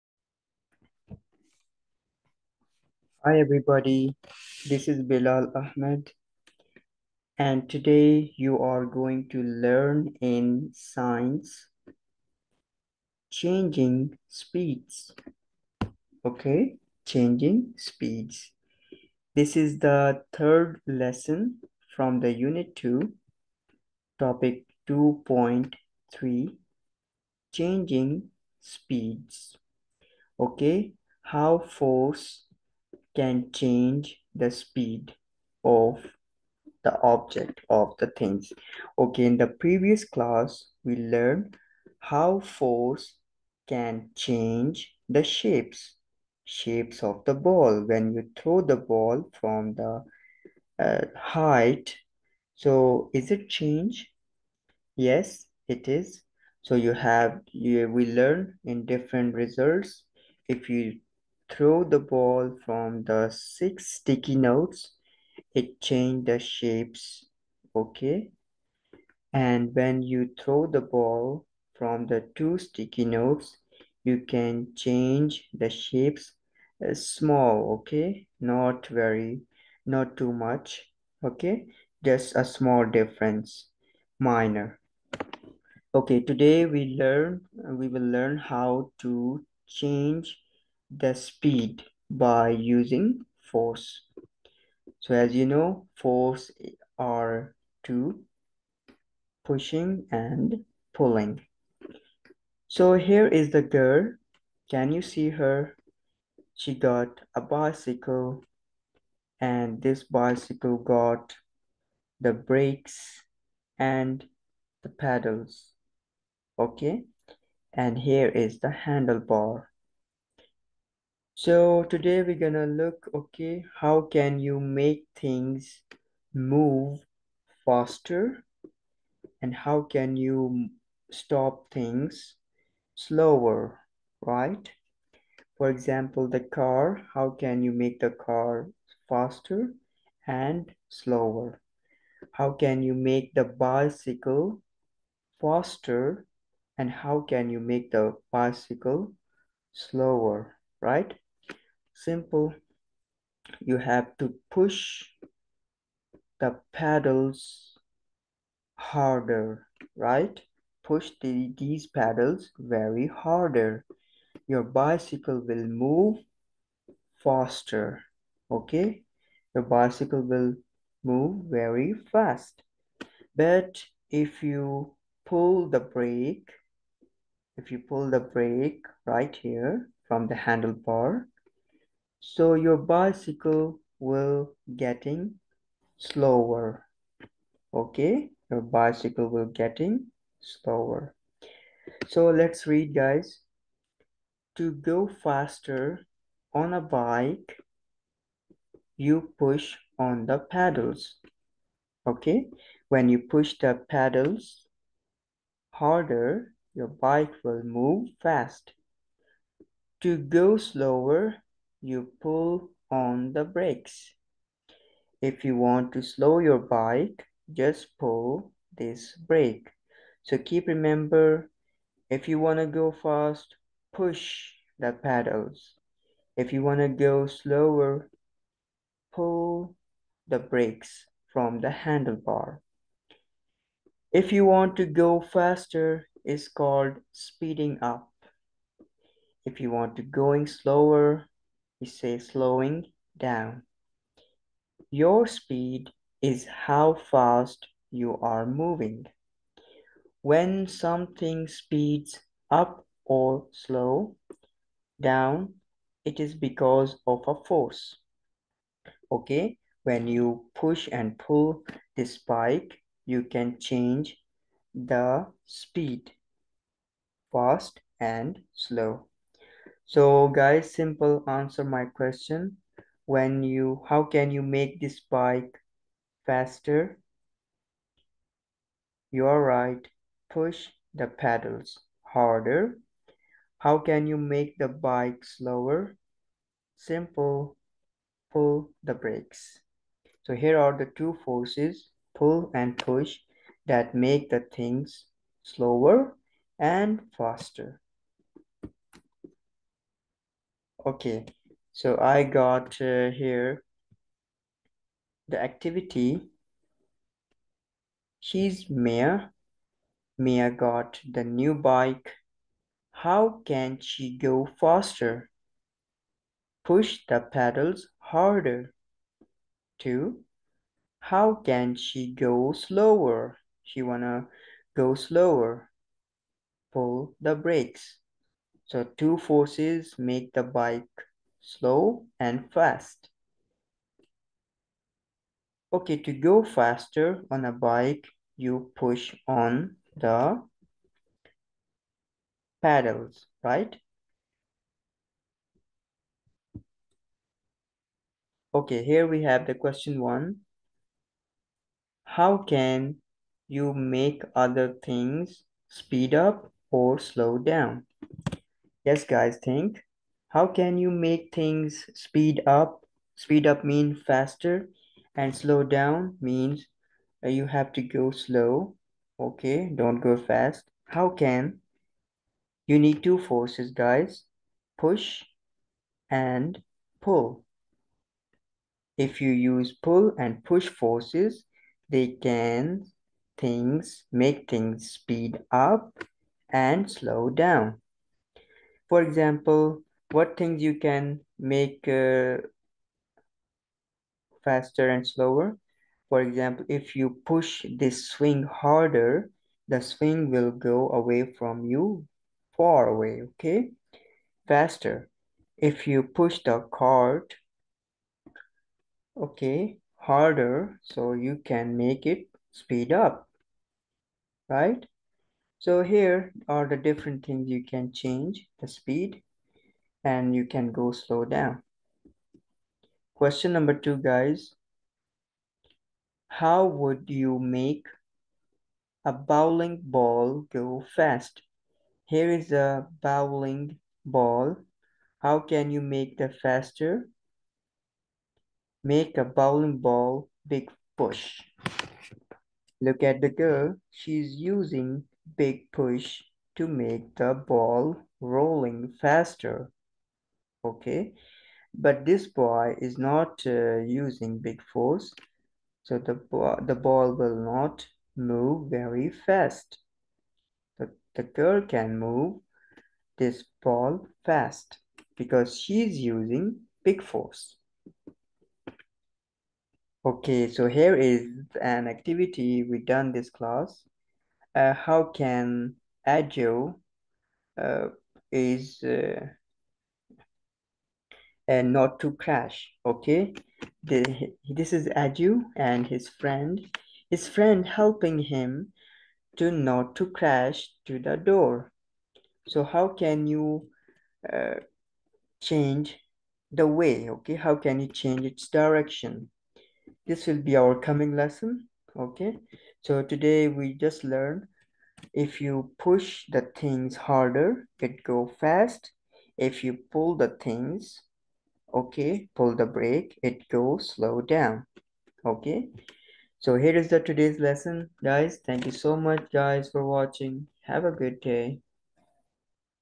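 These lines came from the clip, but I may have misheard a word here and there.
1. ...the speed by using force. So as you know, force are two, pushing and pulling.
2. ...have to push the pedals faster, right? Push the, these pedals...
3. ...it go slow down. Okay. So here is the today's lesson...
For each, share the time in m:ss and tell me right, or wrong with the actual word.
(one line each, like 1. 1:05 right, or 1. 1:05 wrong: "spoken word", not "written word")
1. 1:30 right
2. 2:33 wrong: "harder", not "faster"
3. 8:33 right.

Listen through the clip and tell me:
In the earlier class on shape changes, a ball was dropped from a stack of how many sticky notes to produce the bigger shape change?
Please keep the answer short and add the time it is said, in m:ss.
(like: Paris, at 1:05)
6, at 1:03.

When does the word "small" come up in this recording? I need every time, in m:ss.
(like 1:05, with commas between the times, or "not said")
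1:16, 1:22.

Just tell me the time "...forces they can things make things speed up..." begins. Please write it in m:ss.
6:20.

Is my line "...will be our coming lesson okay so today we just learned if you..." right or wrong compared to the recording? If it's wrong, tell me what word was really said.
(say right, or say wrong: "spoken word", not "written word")
right.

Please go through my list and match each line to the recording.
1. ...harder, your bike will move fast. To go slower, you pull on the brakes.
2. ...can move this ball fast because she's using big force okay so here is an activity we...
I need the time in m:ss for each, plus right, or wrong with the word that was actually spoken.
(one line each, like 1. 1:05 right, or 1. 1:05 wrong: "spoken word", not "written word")
1. 3:25 right
2. 7:41 right.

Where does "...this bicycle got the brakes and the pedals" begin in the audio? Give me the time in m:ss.
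1:49.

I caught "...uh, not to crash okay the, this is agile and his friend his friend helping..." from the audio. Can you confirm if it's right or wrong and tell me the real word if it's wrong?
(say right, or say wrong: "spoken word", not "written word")
right.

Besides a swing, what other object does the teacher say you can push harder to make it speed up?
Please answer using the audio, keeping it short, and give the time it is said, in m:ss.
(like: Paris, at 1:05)
cart, at 6:46.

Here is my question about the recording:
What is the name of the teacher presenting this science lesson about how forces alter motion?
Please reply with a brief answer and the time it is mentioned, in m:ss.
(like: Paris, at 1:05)
Bilal Ahmed, at 0:05.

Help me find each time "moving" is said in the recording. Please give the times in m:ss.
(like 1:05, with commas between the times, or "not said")
4:08.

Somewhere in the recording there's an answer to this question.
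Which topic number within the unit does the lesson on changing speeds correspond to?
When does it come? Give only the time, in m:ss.
0:24.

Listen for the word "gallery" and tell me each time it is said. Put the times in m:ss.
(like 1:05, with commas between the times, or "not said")
not said.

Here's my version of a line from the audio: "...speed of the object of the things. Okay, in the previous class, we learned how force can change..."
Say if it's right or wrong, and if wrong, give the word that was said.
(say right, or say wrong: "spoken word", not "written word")
right.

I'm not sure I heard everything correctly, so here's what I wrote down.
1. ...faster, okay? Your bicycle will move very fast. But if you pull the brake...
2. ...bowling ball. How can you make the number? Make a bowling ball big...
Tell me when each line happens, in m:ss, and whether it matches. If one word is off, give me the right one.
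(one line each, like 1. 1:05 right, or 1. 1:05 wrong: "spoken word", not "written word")
1. 2:47 right
2. 7:12 wrong: "faster", not "number".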